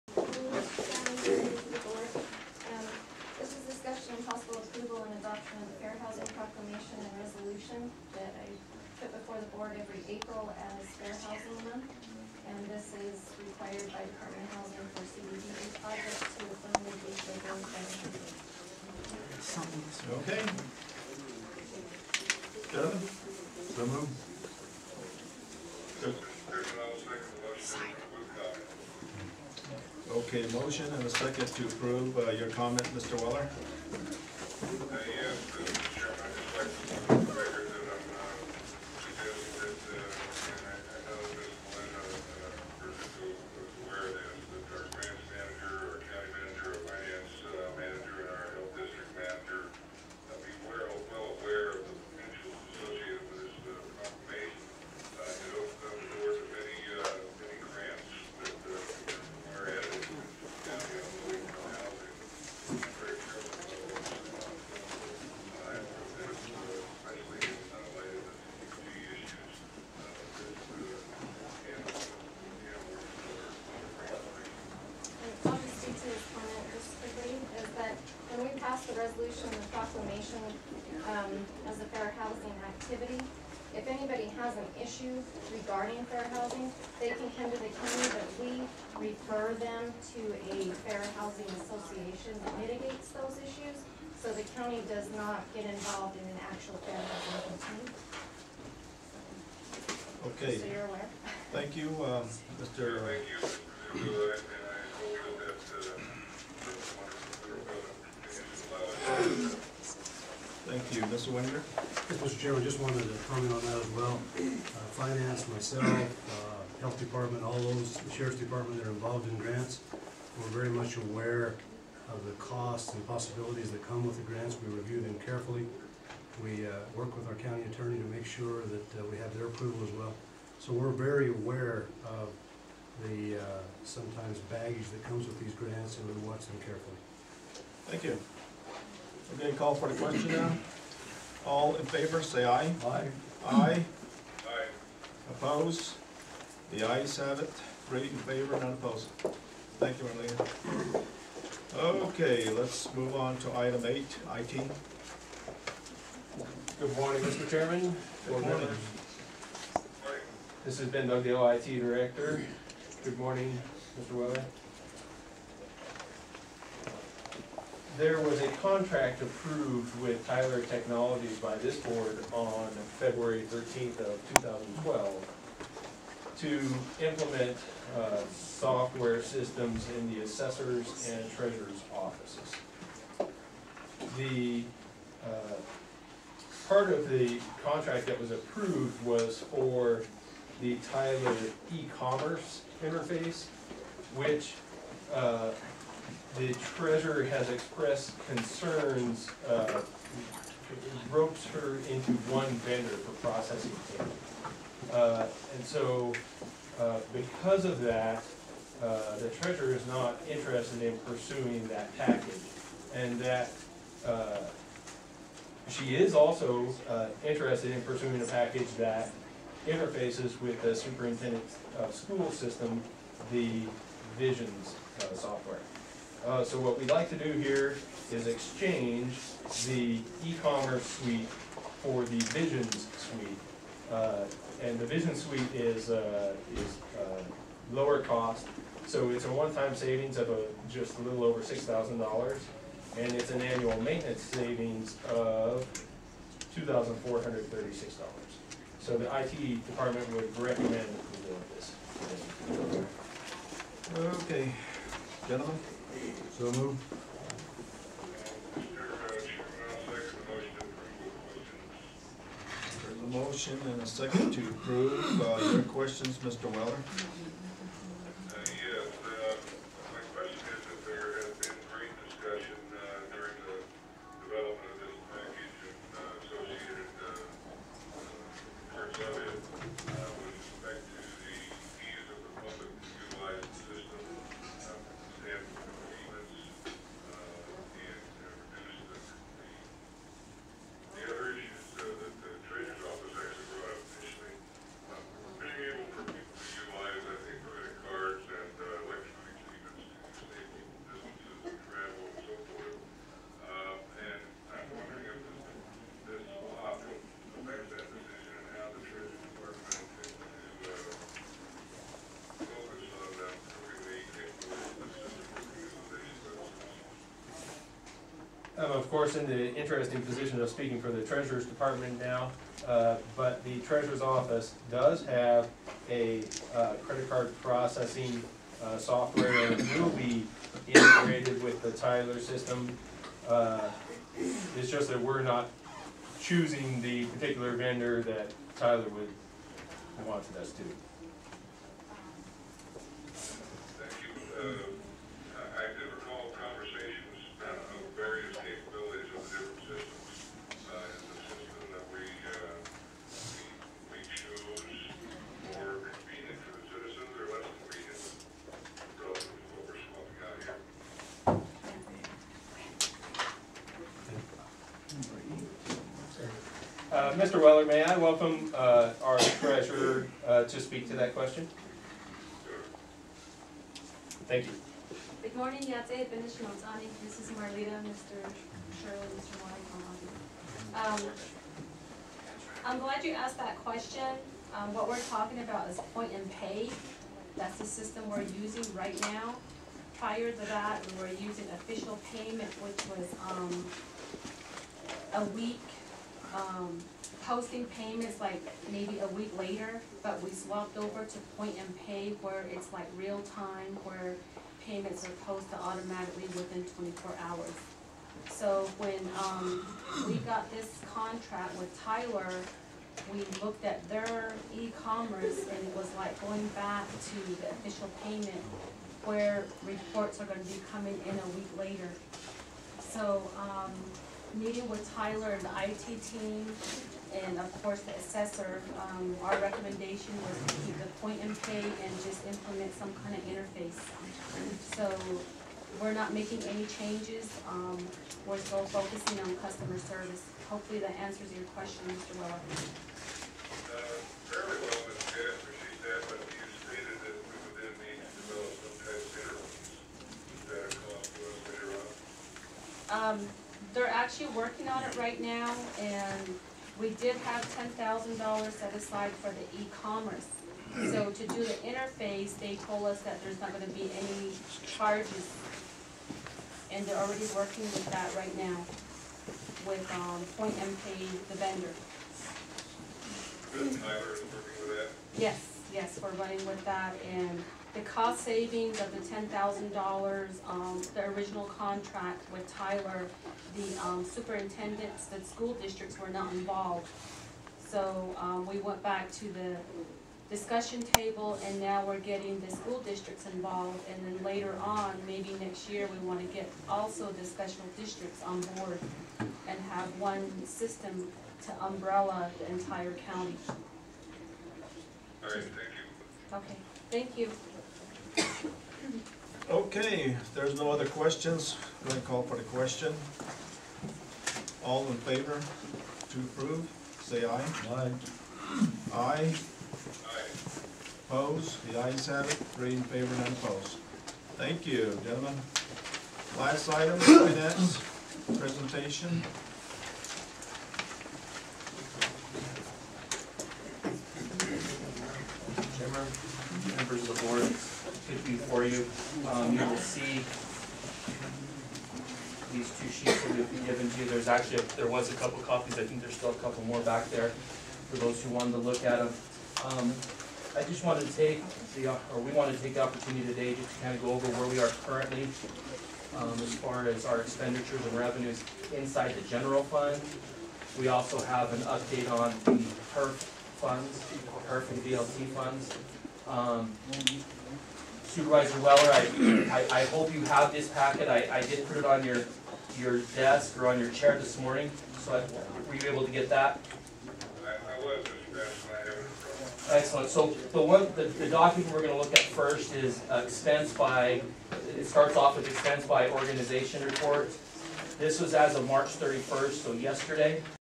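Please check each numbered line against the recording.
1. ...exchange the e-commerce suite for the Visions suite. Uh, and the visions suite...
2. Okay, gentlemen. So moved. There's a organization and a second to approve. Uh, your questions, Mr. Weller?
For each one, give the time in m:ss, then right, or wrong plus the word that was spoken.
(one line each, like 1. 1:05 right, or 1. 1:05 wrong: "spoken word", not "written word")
1. 3:48 right
2. 4:14 wrong: "motion", not "organization".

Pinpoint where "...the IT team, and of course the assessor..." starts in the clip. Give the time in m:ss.
7:05.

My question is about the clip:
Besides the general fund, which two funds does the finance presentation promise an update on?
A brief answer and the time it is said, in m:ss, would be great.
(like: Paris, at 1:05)
HURF and VLT, at 9:24.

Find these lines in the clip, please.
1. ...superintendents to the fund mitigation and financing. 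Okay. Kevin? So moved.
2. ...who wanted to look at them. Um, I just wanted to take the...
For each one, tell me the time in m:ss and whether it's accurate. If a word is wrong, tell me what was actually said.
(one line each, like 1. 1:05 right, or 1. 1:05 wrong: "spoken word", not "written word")
1. 0:15 wrong: "projects", not "superintendents"
2. 9:08 right.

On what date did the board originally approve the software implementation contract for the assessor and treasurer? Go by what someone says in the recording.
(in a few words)
February 13, 2012.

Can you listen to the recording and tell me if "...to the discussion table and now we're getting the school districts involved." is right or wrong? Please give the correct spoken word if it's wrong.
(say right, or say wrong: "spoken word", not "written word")
right.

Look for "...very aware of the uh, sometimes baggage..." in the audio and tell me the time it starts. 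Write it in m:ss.
2:10.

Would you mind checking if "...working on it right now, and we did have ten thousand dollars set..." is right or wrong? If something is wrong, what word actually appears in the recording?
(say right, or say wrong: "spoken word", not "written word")
right.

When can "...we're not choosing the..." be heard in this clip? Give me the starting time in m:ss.
5:35.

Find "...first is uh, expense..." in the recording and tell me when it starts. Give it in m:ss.
9:42.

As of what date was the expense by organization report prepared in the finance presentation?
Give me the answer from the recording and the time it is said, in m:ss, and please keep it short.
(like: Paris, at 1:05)
March 31st, at 9:48.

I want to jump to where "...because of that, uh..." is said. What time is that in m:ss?
3:27.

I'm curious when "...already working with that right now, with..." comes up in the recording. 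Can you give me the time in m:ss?
7:46.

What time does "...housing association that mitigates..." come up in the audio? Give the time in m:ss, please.
1:31.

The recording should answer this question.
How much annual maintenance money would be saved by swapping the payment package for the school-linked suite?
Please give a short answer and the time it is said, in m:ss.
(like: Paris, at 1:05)
$2,436, at 4:06.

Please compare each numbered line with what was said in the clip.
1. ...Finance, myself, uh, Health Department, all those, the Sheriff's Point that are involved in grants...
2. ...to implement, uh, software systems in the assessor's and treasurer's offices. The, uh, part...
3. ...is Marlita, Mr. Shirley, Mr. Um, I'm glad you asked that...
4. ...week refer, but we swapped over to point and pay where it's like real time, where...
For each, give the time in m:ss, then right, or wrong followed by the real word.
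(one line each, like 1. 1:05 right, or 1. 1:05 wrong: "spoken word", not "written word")
1. 1:54 wrong: "Department", not "Point"
2. 2:56 right
3. 6:17 right
4. 6:39 wrong: "later", not "refer".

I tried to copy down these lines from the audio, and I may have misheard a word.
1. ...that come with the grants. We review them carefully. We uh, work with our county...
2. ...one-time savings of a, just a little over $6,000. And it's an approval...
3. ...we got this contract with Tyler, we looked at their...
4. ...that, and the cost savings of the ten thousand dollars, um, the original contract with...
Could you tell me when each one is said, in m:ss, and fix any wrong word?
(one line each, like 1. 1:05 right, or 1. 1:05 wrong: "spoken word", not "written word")
1. 2:03 right
2. 3:59 wrong: "annual", not "approval"
3. 6:50 right
4. 7:56 right.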